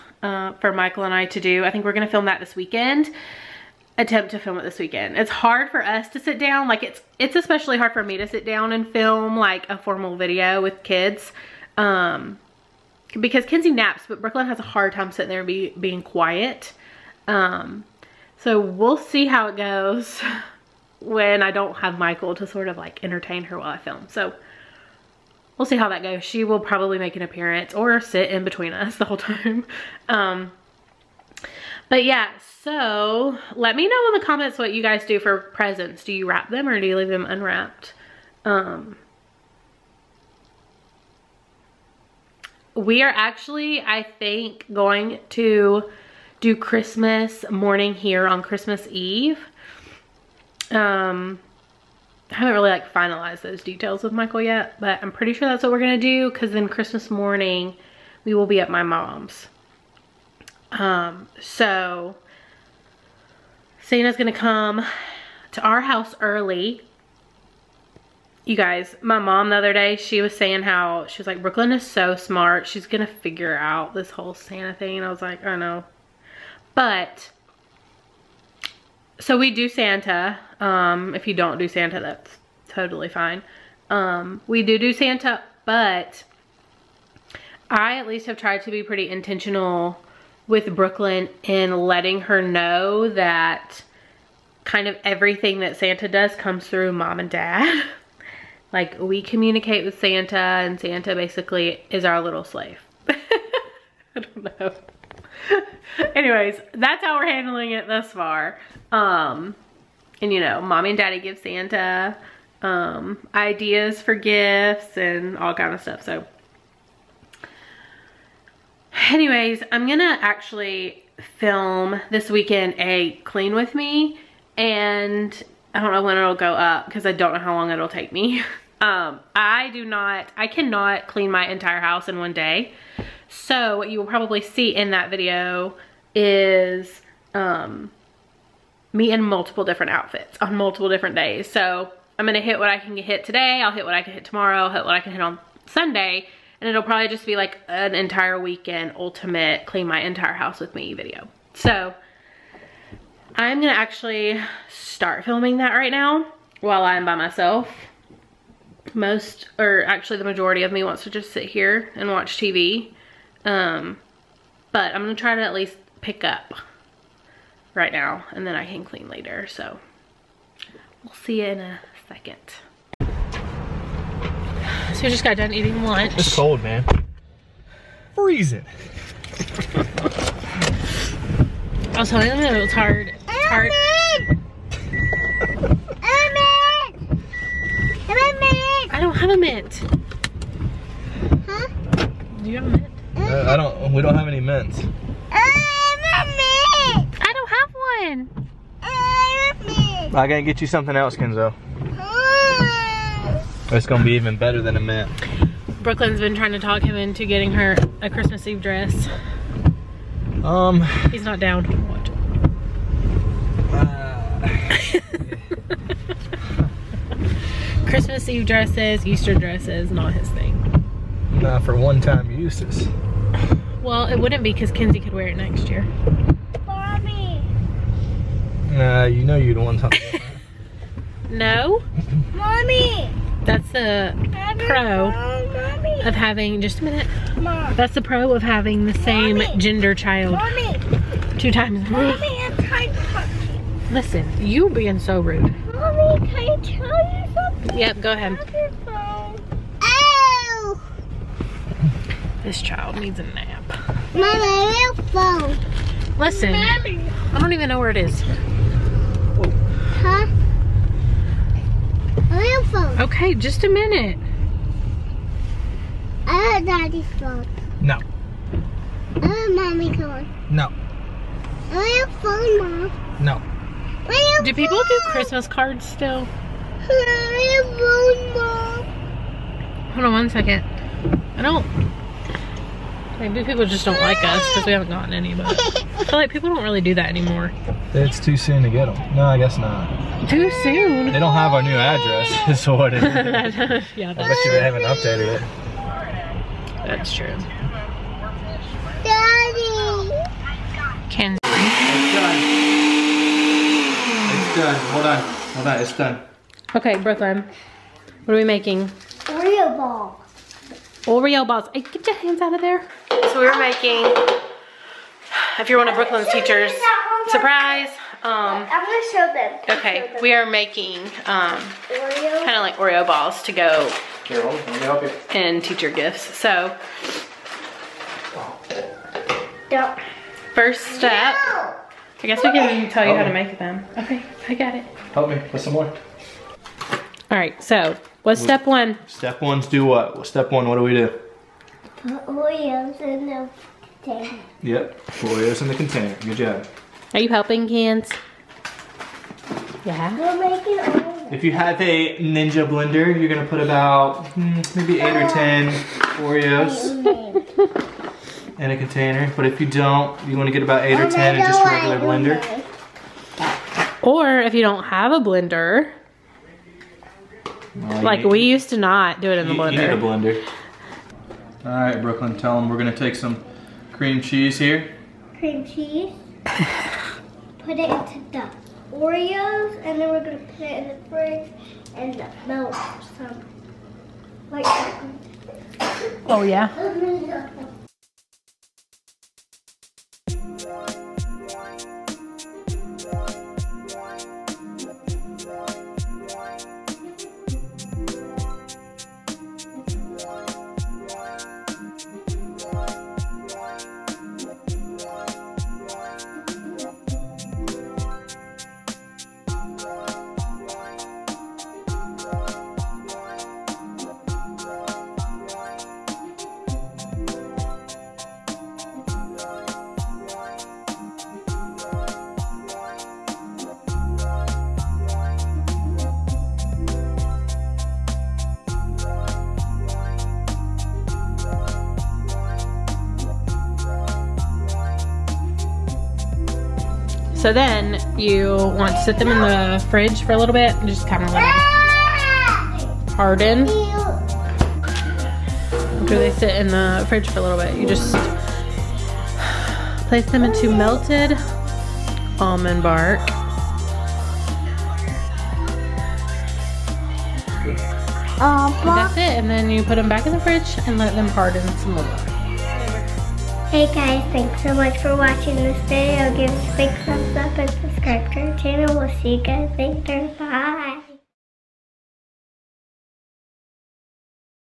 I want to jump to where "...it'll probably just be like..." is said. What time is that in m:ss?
2:26.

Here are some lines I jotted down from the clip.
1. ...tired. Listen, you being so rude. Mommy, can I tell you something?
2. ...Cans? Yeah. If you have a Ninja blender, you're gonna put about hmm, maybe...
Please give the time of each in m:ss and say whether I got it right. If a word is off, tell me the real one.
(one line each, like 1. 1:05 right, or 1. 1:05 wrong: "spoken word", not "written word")
1. 4:02 right
2. 5:47 right.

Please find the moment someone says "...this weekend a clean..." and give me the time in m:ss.
2:02.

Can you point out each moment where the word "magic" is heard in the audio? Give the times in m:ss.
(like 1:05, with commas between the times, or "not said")
not said.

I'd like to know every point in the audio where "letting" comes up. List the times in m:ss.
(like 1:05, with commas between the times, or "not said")
1:31.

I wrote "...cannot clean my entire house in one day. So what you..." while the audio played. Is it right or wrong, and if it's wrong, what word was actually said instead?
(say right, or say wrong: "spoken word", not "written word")
right.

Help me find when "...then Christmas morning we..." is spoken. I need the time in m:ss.
0:56.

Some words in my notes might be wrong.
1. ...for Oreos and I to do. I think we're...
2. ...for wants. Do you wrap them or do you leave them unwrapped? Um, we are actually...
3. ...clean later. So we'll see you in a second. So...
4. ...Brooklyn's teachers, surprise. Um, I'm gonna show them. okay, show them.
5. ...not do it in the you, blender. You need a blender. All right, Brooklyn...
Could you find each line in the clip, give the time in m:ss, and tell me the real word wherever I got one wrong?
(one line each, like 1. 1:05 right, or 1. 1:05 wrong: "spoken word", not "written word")
1. 0:00 wrong: "Michael", not "Oreos"
2. 0:35 wrong: "presents", not "wants"
3. 2:48 right
4. 5:15 right
5. 6:08 right.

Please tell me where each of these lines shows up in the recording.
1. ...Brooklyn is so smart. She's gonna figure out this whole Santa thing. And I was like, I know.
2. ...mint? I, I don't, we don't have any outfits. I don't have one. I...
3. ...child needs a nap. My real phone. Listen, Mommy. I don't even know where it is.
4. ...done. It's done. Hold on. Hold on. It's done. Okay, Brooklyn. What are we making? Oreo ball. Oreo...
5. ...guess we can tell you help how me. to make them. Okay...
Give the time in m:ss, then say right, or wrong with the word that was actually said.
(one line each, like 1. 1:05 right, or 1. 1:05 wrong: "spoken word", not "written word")
1. 1:11 right
2. 3:12 wrong: "mints", not "outfits"
3. 4:12 right
4. 5:04 right
5. 5:32 right.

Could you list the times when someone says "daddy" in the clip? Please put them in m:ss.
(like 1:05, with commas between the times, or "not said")
1:50, 4:26, 4:59.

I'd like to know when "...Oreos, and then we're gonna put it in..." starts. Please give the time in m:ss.
6:18.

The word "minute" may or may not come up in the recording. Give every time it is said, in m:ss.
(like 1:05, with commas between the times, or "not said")
3:56, 4:23.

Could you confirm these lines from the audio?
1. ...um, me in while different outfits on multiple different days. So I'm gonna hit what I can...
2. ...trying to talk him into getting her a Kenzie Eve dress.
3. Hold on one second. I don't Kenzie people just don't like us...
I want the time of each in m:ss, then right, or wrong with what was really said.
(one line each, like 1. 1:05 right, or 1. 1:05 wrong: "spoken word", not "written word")
1. 2:17 wrong: "multiple", not "while"
2. 3:26 wrong: "Christmas", not "Kenzie"
3. 4:39 wrong: "Maybe", not "Kenzie".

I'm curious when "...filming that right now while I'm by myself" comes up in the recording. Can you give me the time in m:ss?
2:35.